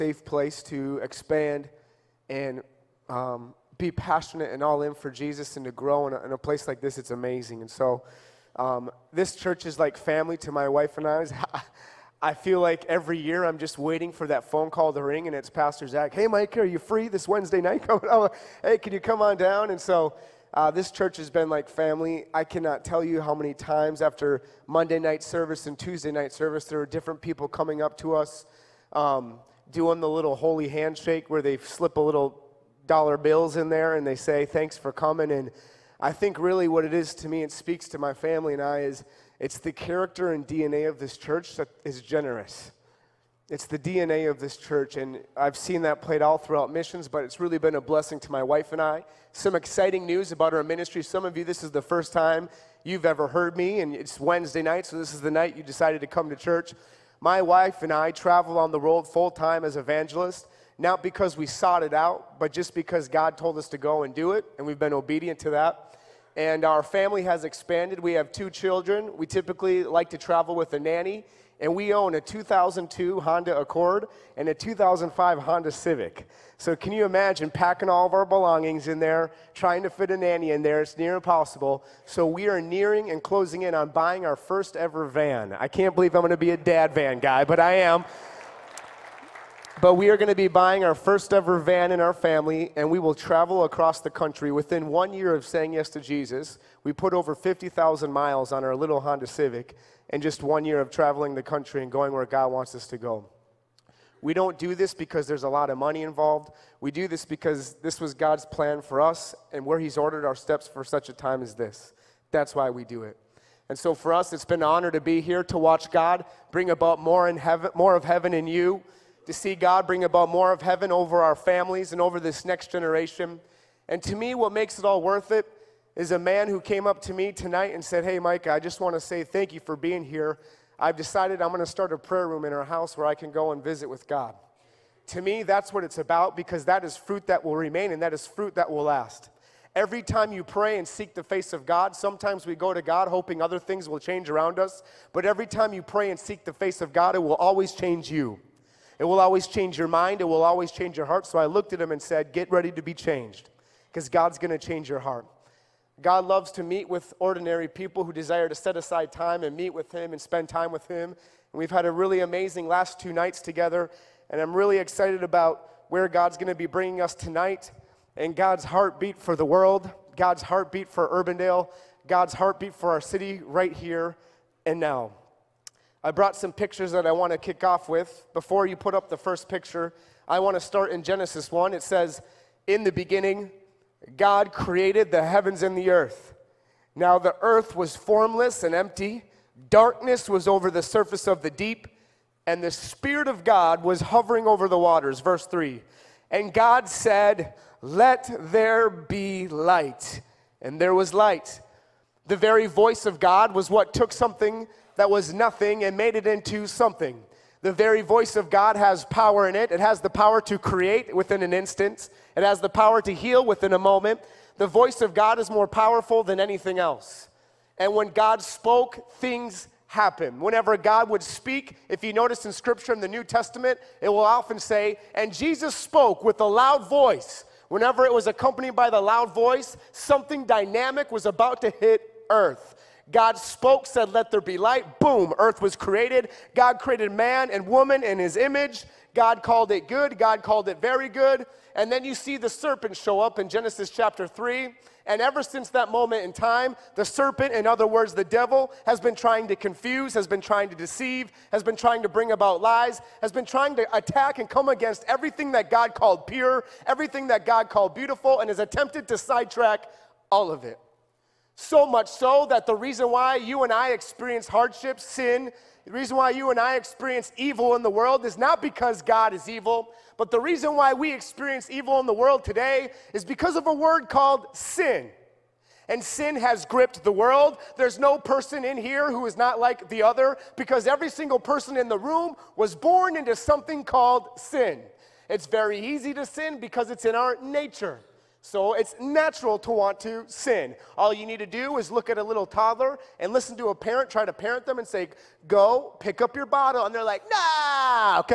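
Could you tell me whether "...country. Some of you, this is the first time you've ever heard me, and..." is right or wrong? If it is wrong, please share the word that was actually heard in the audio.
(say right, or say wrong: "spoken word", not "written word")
wrong: "ministry", not "country".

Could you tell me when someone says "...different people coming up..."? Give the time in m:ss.
0:26.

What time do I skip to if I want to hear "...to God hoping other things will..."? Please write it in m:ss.
2:22.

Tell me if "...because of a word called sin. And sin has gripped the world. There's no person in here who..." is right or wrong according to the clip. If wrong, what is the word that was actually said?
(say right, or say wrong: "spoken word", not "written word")
right.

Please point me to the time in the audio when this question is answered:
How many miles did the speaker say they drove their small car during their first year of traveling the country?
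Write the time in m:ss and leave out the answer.
1:37.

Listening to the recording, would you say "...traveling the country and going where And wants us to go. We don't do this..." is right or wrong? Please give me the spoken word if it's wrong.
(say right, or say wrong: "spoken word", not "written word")
wrong: "God", not "And".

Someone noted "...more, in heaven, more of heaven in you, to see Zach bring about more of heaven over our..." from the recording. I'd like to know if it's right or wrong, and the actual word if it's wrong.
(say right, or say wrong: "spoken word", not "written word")
wrong: "God", not "Zach".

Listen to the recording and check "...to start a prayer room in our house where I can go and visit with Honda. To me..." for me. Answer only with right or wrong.
wrong.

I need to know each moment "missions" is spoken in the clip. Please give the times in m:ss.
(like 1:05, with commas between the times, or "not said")
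0:46.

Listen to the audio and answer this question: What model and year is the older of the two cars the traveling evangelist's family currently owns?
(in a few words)
2002 Honda Accord.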